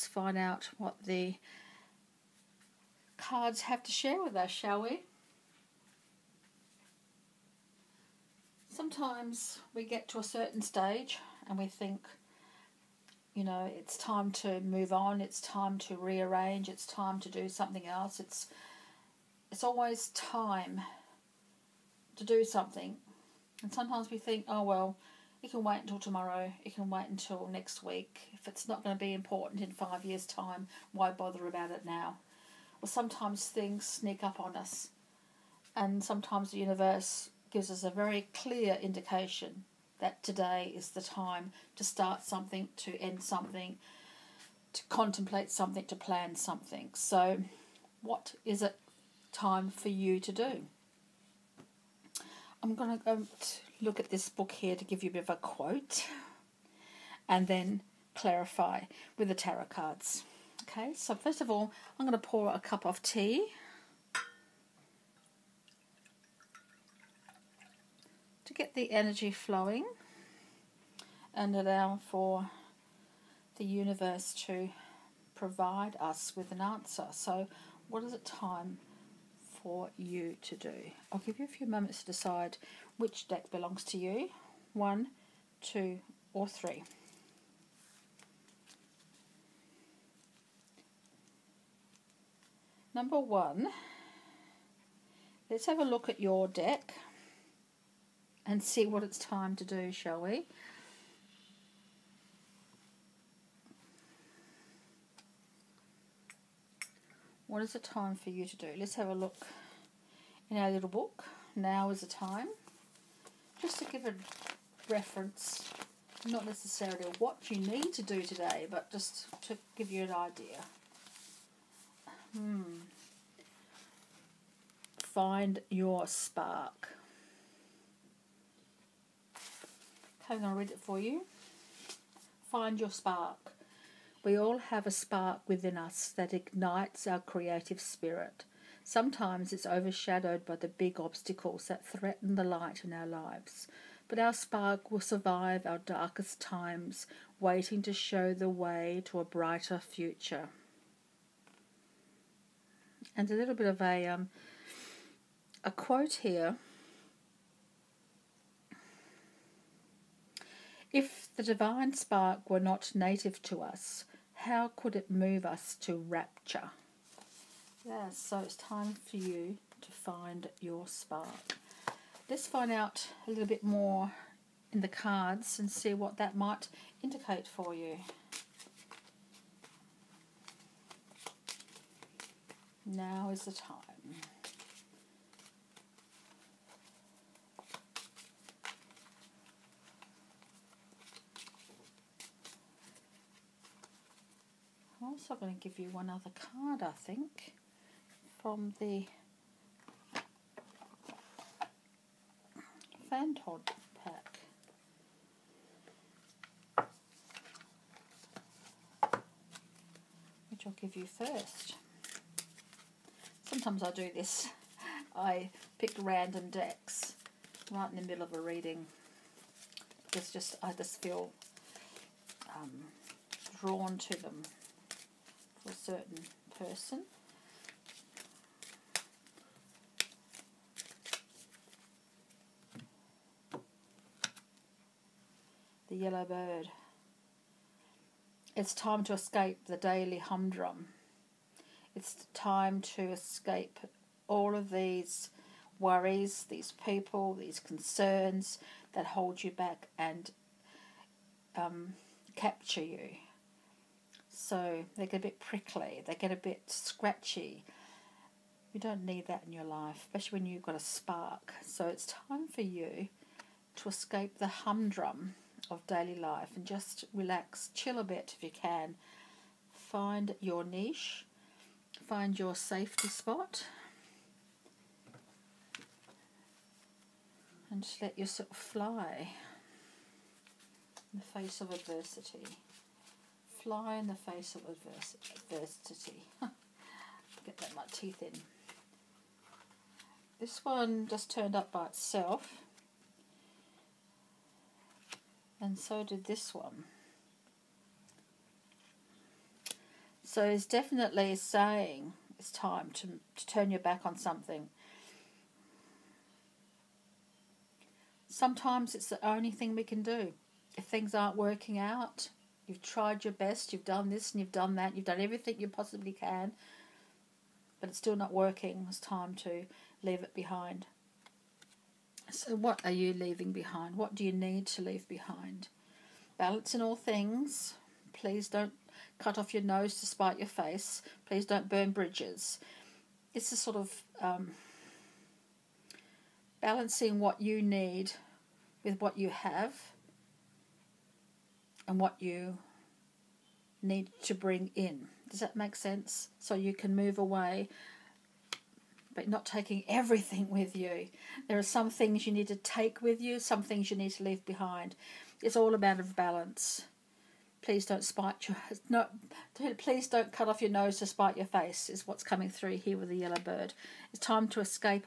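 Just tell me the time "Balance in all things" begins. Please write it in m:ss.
5:26.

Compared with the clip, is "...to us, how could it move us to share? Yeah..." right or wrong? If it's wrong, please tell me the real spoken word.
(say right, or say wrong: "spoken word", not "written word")
wrong: "rapture", not "share".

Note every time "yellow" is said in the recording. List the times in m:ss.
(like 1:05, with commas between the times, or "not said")
3:55, 6:03.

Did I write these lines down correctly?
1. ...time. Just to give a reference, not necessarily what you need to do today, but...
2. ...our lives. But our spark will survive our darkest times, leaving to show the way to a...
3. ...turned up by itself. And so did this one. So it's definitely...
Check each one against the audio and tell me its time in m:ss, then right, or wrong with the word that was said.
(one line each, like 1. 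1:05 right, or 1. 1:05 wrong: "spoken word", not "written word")
1. 1:52 right
2. 2:22 wrong: "waiting", not "leaving"
3. 4:51 right.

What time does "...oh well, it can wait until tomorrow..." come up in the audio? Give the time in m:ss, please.
0:24.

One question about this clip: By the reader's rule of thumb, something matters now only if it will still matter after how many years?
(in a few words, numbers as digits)
5.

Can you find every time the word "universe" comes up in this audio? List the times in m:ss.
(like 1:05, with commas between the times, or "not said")
0:36, 1:13.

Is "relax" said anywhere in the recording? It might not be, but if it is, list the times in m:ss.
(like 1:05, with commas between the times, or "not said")
4:27.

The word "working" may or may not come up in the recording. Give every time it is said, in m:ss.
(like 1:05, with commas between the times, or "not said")
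5:11, 5:18.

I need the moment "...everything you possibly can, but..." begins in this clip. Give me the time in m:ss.
5:15.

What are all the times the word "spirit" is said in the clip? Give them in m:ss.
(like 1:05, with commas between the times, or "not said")
2:17.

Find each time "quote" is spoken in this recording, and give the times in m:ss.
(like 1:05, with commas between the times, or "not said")
0:55, 2:35.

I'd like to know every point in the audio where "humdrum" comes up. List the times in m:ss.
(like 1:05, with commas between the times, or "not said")
4:00, 4:24.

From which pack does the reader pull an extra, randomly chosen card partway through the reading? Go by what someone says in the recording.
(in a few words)
Fantod.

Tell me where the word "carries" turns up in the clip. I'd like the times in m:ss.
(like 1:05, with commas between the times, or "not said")
not said.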